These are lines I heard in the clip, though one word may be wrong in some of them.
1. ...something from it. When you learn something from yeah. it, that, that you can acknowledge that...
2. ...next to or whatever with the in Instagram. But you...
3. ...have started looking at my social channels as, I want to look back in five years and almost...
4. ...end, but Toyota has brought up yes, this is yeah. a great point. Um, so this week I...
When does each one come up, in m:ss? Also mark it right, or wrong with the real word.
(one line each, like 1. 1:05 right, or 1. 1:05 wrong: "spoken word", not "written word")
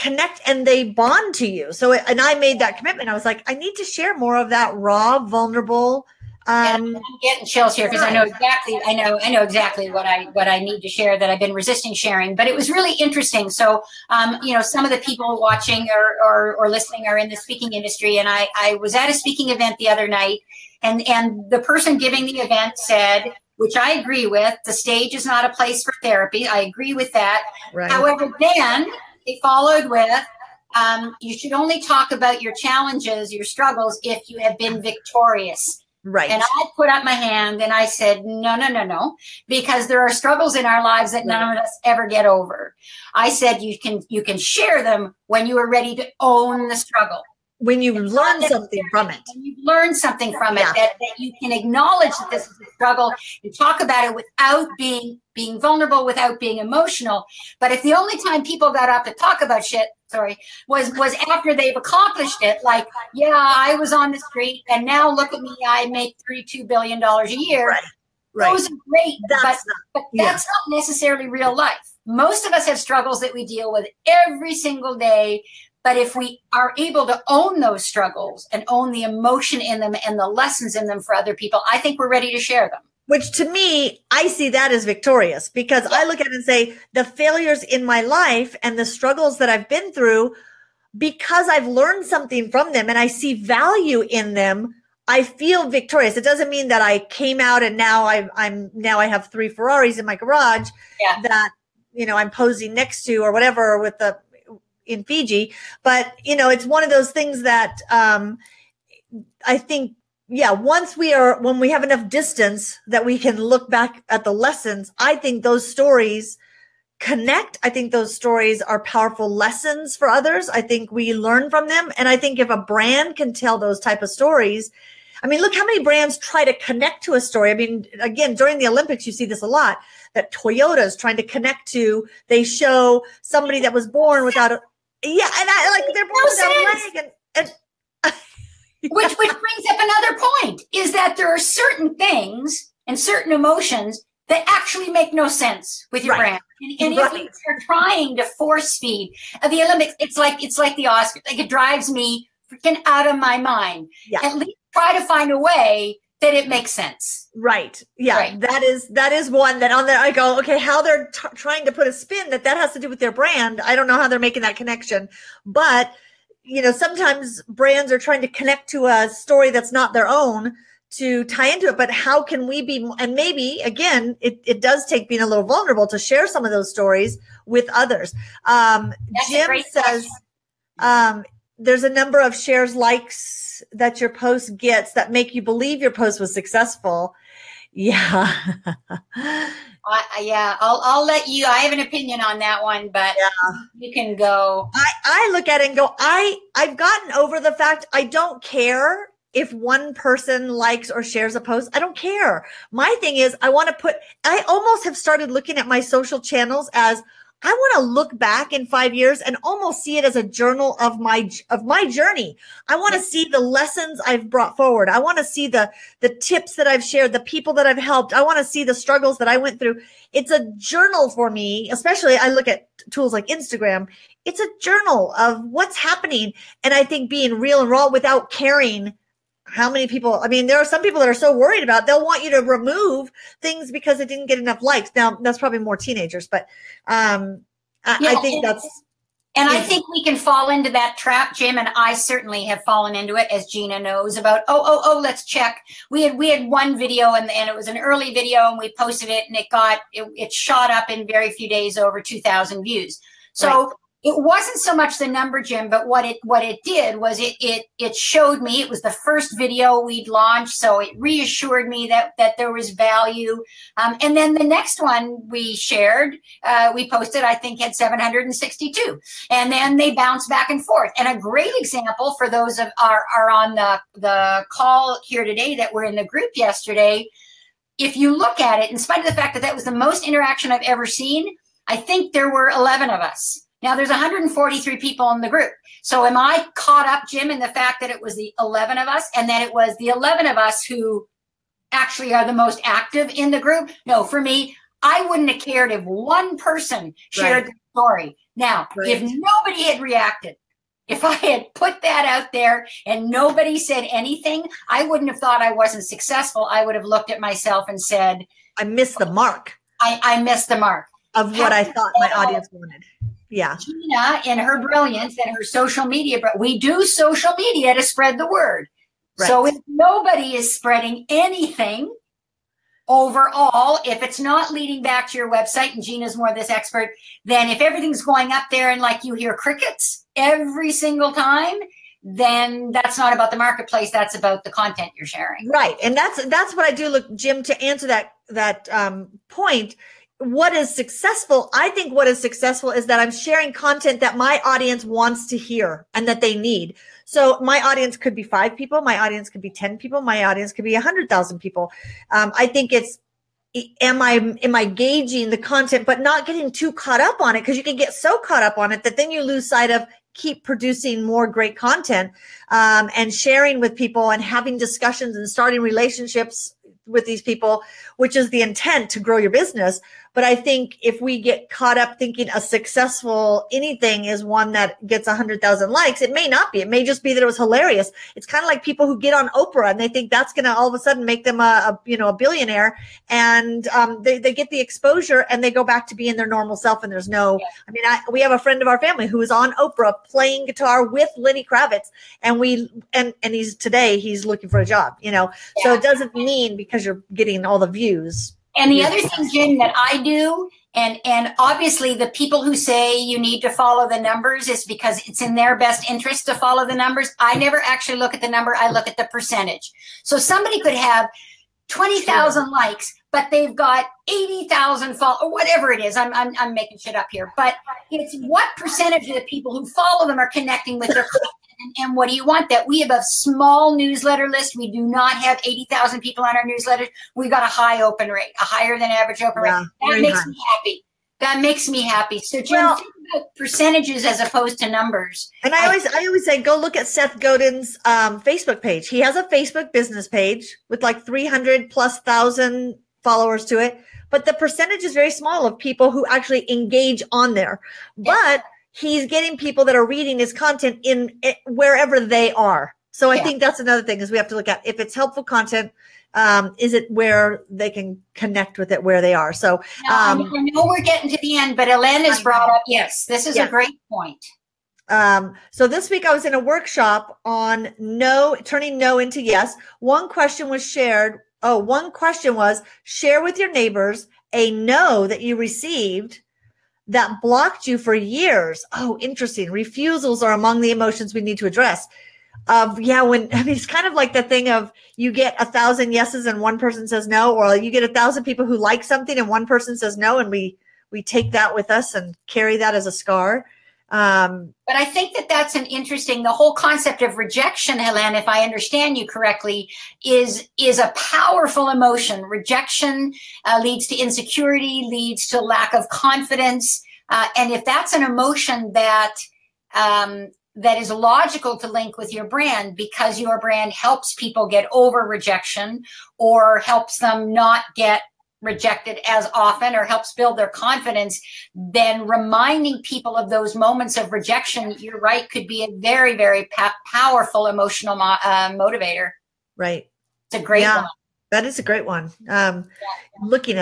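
1. 0:48 right
2. 1:42 wrong: "Fiji", not "Instagram"
3. 3:24 right
4. 7:41 wrong: "Elaine", not "Toyota".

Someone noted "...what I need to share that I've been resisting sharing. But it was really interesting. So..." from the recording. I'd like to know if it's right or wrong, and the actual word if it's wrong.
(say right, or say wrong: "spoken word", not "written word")
right.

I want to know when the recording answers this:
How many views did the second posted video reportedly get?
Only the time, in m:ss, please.
4:27.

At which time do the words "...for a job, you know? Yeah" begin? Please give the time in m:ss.
6:34.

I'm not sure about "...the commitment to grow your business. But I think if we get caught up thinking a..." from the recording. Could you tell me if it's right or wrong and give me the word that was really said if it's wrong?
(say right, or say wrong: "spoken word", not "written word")
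wrong: "intent", not "commitment".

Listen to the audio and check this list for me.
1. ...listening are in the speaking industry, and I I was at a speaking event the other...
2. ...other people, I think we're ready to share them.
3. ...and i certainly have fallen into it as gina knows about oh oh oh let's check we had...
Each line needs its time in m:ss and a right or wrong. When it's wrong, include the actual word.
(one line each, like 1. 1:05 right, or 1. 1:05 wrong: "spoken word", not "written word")
1. 0:16 right
2. 1:21 right
3. 4:01 right.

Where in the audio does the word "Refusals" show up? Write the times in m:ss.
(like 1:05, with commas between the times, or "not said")
7:59.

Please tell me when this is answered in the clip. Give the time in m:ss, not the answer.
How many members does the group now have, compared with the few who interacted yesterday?
4:43.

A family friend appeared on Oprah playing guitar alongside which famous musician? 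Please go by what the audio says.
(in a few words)
Lenny Kravitz.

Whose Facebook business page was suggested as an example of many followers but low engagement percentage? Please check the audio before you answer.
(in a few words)
Seth Godin.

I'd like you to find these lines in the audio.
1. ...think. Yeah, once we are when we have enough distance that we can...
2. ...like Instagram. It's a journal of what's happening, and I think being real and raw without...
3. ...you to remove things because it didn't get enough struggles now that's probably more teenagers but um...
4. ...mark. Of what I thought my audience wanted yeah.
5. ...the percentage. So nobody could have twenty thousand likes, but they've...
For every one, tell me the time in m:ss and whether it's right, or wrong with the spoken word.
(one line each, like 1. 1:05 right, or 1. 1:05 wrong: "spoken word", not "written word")
1. 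1:49 right
2. 3:43 right
3. 3:52 wrong: "likes", not "struggles"
4. 5:10 right
5. 6:48 wrong: "somebody", not "nobody".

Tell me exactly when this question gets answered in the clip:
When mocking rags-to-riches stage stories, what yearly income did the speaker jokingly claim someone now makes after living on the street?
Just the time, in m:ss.
1:06.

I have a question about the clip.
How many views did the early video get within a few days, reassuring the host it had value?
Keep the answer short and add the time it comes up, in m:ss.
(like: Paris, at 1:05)
2000, at 4:12.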